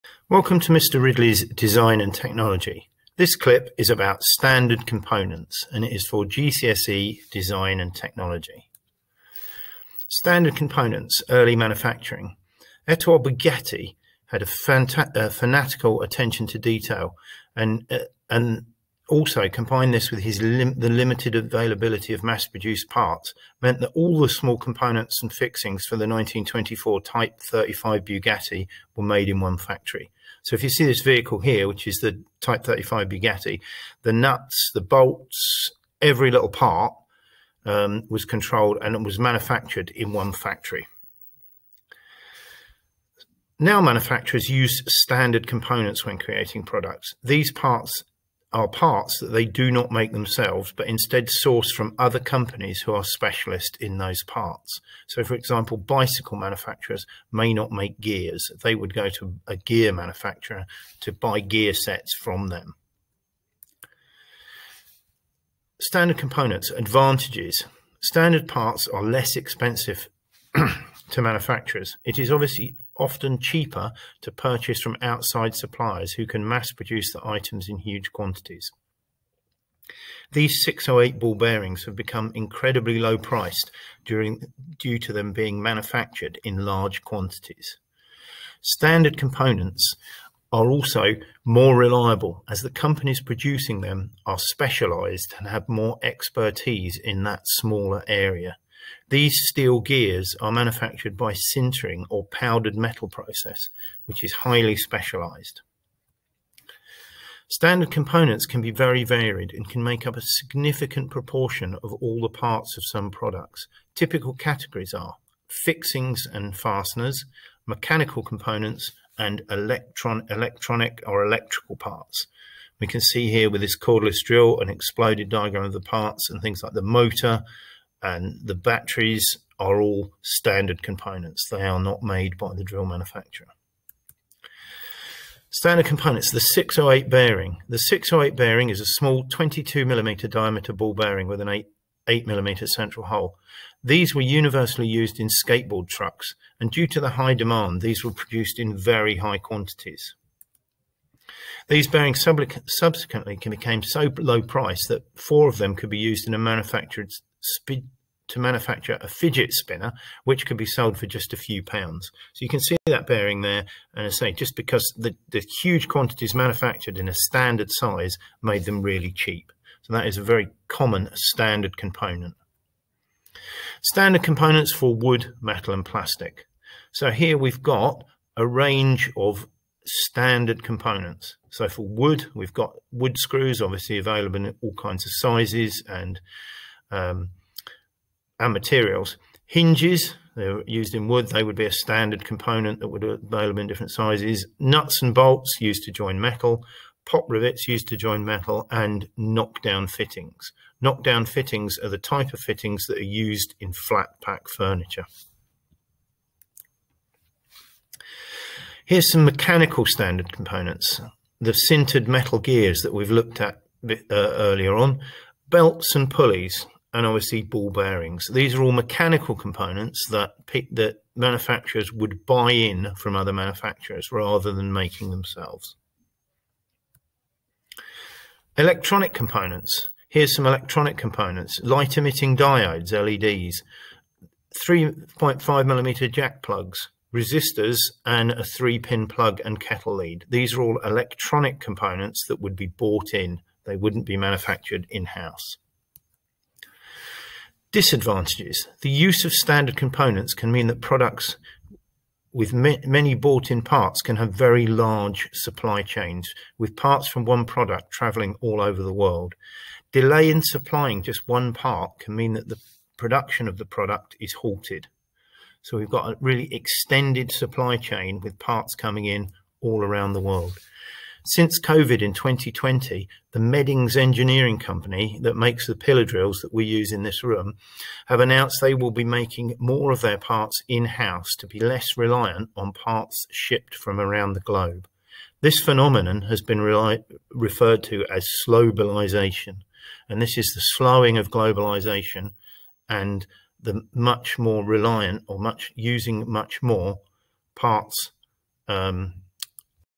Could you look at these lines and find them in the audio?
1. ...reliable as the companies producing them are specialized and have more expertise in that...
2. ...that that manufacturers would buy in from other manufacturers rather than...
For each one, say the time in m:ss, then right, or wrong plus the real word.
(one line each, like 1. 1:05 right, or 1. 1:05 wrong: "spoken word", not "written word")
1. 1:31 right
2. 3:40 right.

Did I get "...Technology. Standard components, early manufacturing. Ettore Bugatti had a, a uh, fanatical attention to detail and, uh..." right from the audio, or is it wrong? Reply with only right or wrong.
right.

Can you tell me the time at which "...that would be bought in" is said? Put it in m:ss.
4:02.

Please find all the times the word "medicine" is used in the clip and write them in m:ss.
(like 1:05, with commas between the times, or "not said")
not said.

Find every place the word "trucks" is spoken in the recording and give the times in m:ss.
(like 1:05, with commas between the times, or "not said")
2:25.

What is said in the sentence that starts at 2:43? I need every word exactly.
And I say, just because the, the huge quantities manufactured in a standard size made them really cheap.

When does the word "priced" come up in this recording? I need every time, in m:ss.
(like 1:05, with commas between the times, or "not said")
1:23, 2:34.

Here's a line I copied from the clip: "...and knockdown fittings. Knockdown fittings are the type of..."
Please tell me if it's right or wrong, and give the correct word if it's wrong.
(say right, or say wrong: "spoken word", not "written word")
right.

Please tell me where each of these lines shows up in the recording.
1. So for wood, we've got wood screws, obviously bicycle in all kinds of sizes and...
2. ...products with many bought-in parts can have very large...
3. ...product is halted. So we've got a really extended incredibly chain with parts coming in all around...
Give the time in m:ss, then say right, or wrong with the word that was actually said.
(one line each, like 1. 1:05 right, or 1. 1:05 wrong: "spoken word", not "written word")
1. 3:01 wrong: "available", not "bicycle"
2. 4:10 right
3. 4:23 wrong: "supply", not "incredibly".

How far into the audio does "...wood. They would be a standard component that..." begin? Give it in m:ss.
3:11.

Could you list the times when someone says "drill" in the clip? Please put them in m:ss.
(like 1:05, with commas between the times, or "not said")
2:04, 2:12, 4:36.